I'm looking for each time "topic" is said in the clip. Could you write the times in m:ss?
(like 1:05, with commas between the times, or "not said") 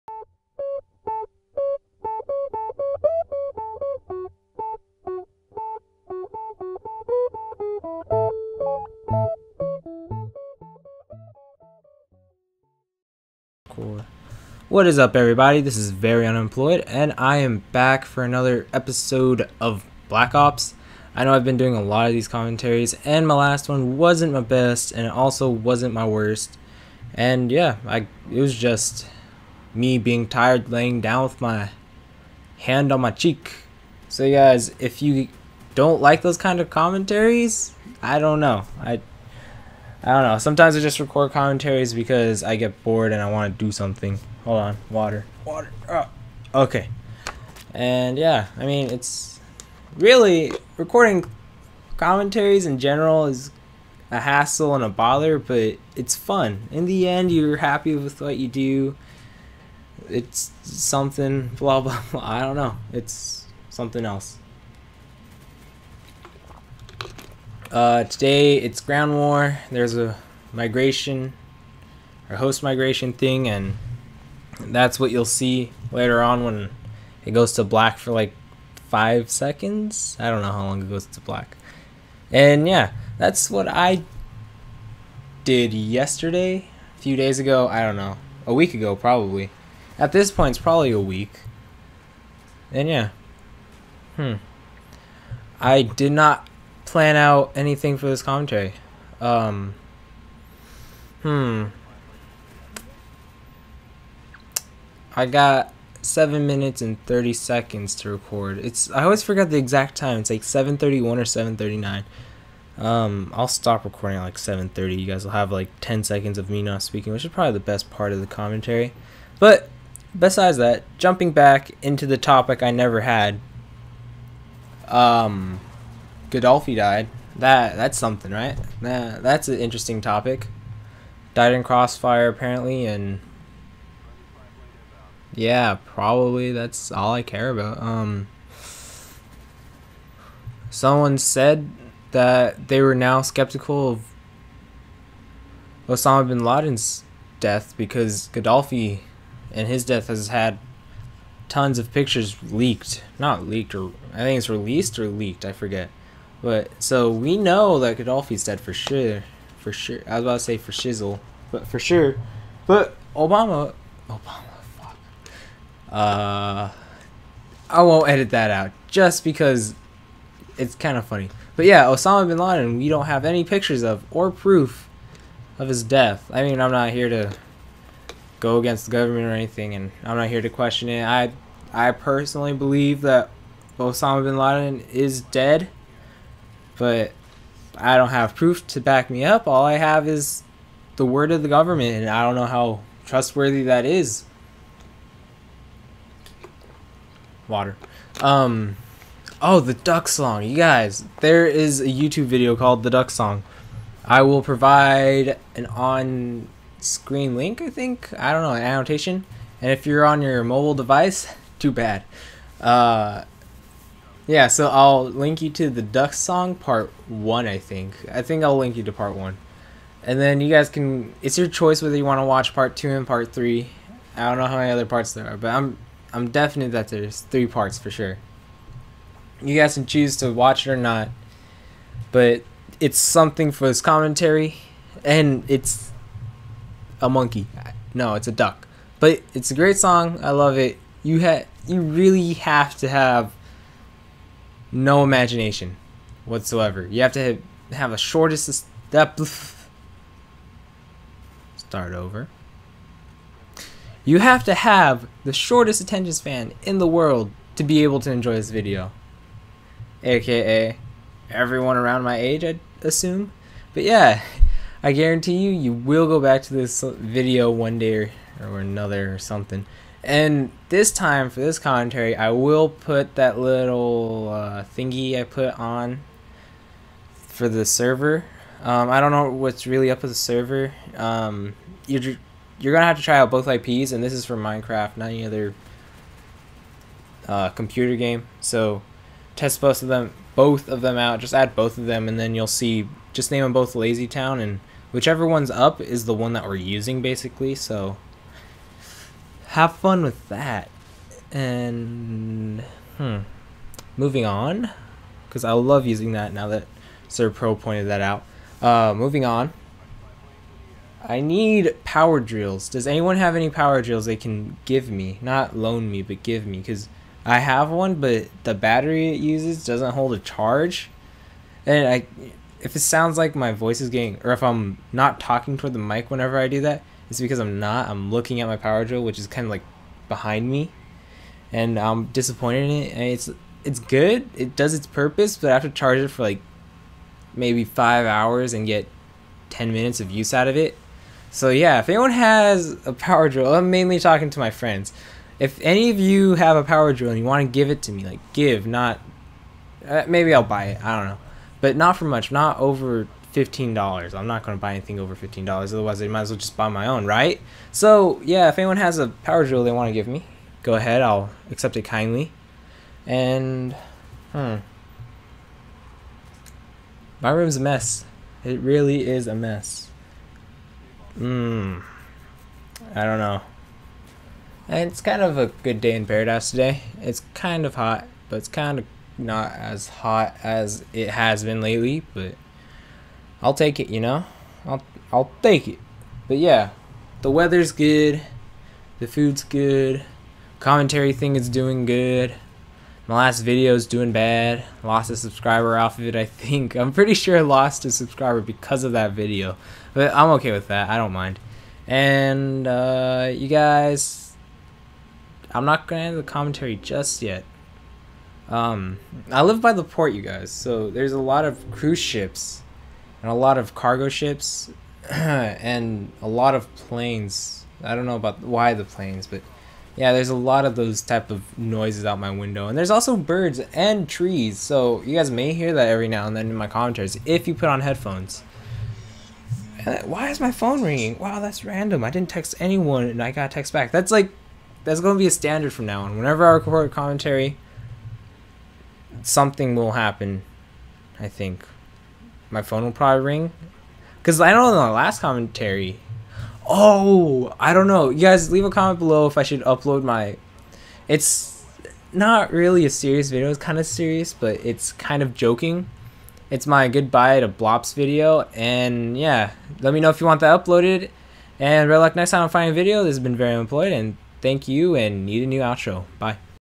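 2:02, 2:10.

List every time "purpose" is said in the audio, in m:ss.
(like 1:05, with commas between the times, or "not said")
5:34.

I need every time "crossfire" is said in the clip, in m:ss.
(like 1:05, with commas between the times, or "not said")
2:11.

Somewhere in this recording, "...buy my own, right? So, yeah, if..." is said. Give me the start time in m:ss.
5:56.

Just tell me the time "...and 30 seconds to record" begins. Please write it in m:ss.
1:46.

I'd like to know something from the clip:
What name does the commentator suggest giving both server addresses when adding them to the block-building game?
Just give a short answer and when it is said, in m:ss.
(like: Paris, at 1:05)
Lazy Town, at 4:53.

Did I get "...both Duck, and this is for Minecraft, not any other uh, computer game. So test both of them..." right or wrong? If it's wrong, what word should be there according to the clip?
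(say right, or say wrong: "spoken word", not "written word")
wrong: "IPs", not "Duck".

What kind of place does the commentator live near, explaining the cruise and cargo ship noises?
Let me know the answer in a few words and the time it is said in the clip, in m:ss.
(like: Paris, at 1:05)
The port, at 6:49.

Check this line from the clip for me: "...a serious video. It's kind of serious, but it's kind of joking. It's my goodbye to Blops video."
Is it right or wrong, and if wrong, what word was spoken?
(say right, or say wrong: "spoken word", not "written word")
right.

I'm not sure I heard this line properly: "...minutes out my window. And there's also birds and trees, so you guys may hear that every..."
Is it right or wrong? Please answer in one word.
wrong.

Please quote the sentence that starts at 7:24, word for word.
Because I don't know the last commentary.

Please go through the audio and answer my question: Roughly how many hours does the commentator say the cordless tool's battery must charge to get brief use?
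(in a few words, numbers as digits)
5.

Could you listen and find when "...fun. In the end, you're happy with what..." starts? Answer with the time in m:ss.
0:56.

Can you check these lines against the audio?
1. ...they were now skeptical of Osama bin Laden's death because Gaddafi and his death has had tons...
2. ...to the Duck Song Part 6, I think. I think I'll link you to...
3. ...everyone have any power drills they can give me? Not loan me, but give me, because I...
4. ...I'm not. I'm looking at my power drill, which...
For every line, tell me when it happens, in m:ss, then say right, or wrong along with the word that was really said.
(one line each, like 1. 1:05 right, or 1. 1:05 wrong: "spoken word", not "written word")
1. 2:22 right
2. 3:35 wrong: "1", not "6"
3. 5:12 wrong: "anyone", not "everyone"
4. 5:27 right.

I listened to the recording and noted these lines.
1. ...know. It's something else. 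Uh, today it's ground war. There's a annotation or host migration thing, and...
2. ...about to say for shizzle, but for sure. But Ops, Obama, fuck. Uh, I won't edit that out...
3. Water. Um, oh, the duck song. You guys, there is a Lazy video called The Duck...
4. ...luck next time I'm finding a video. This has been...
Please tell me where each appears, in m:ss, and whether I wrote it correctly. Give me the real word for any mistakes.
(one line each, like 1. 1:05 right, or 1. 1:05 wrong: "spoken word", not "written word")
1. 1:02 wrong: "migration", not "annotation"
2. 2:40 wrong: "Obama", not "Ops"
3. 3:17 wrong: "YouTube", not "Lazy"
4. 7:41 right.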